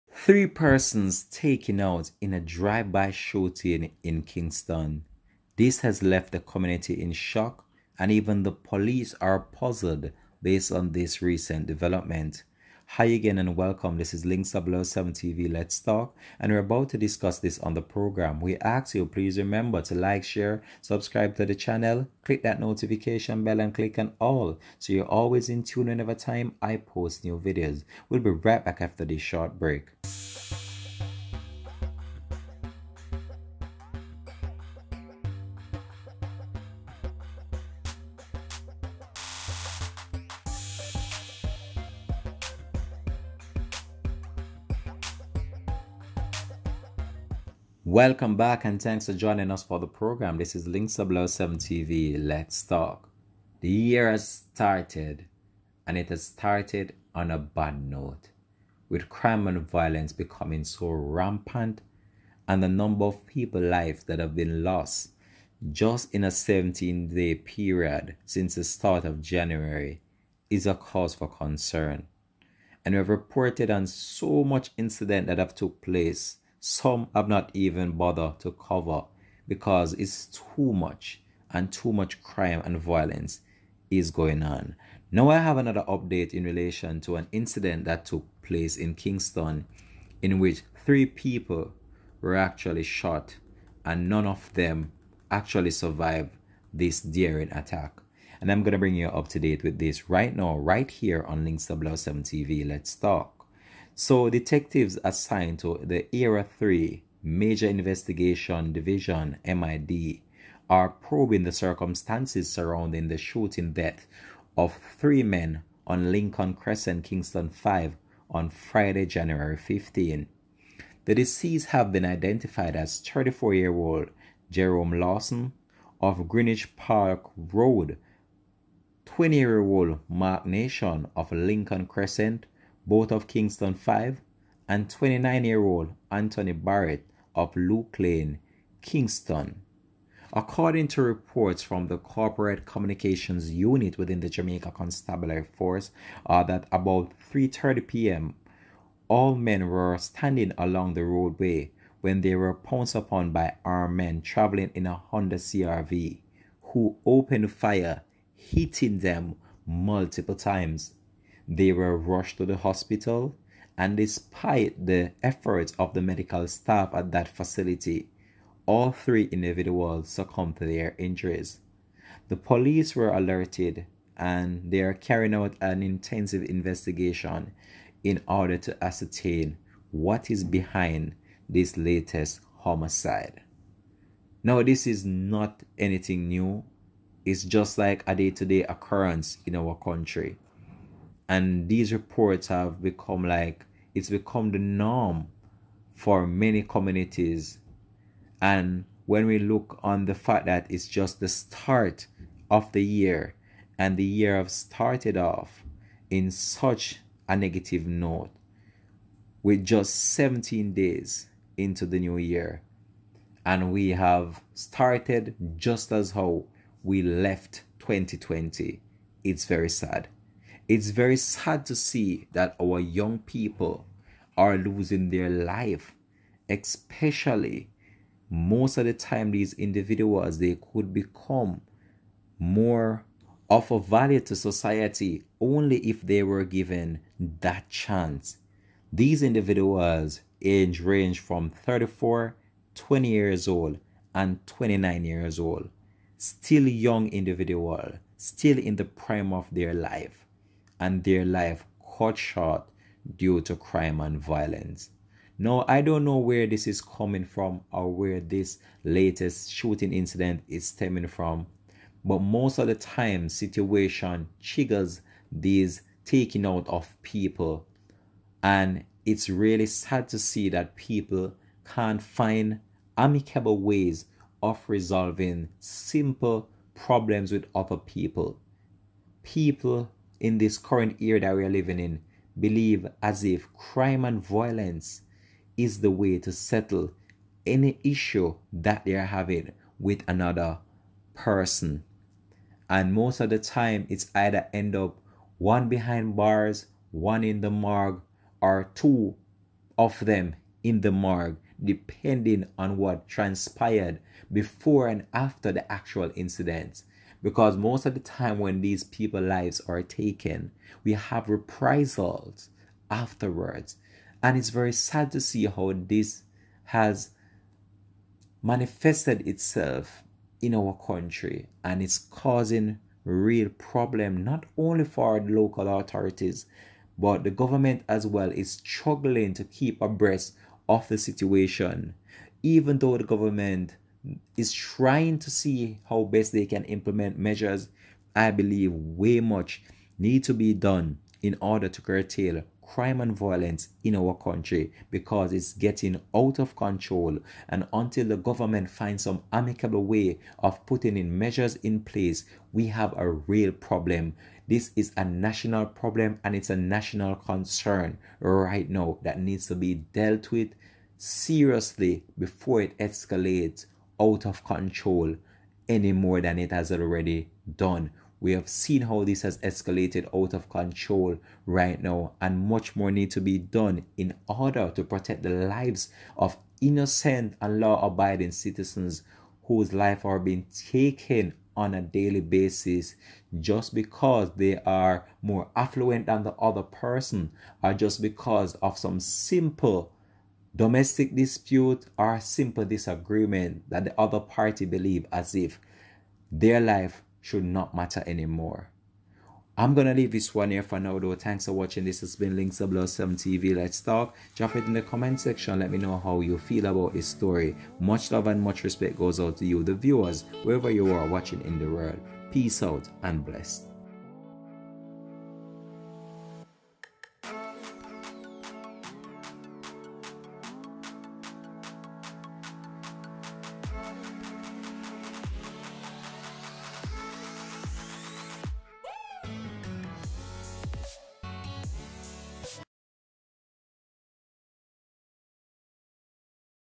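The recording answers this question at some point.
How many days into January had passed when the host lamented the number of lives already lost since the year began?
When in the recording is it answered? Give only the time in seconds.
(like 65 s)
66 s.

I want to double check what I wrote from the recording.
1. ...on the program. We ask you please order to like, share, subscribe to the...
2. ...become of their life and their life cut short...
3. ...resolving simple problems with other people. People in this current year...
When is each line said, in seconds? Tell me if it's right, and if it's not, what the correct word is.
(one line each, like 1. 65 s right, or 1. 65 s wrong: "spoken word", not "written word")
1. 17 s wrong: "remember", not "order"
2. 248 s wrong: "prime", not "become"
3. 274 s right.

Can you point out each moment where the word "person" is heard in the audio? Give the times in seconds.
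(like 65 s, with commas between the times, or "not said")
0 s, 291 s, 386 s.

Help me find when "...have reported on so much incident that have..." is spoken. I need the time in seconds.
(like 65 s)
72 s.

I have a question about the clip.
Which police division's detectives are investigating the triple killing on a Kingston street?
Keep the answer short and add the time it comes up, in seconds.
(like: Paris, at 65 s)
Area 3 Major Investigation Division, at 106 s.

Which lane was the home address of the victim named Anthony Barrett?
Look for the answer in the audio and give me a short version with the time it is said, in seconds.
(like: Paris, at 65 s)
Luke Lane, at 137 s.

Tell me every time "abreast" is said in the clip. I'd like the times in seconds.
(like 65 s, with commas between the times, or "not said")
329 s.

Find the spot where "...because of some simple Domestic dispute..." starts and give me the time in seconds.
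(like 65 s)
388 s.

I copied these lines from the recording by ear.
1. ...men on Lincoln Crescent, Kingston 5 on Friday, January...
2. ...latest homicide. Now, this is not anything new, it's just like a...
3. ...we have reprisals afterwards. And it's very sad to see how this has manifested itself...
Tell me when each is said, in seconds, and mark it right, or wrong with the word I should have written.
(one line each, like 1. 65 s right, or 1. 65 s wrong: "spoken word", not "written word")
1. 115 s right
2. 181 s right
3. 310 s right.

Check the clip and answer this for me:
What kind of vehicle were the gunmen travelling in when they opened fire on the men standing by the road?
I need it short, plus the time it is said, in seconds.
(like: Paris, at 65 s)
Honda CRV, at 154 s.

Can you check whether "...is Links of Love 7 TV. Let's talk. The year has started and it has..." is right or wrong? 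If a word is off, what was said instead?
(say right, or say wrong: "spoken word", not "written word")
right.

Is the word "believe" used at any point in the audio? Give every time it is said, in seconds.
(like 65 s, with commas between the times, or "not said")
282 s, 338 s, 394 s.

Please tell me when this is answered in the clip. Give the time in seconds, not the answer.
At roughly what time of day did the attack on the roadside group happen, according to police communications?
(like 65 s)
147 s.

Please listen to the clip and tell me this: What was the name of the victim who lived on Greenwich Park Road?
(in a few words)
Jerome Lawson.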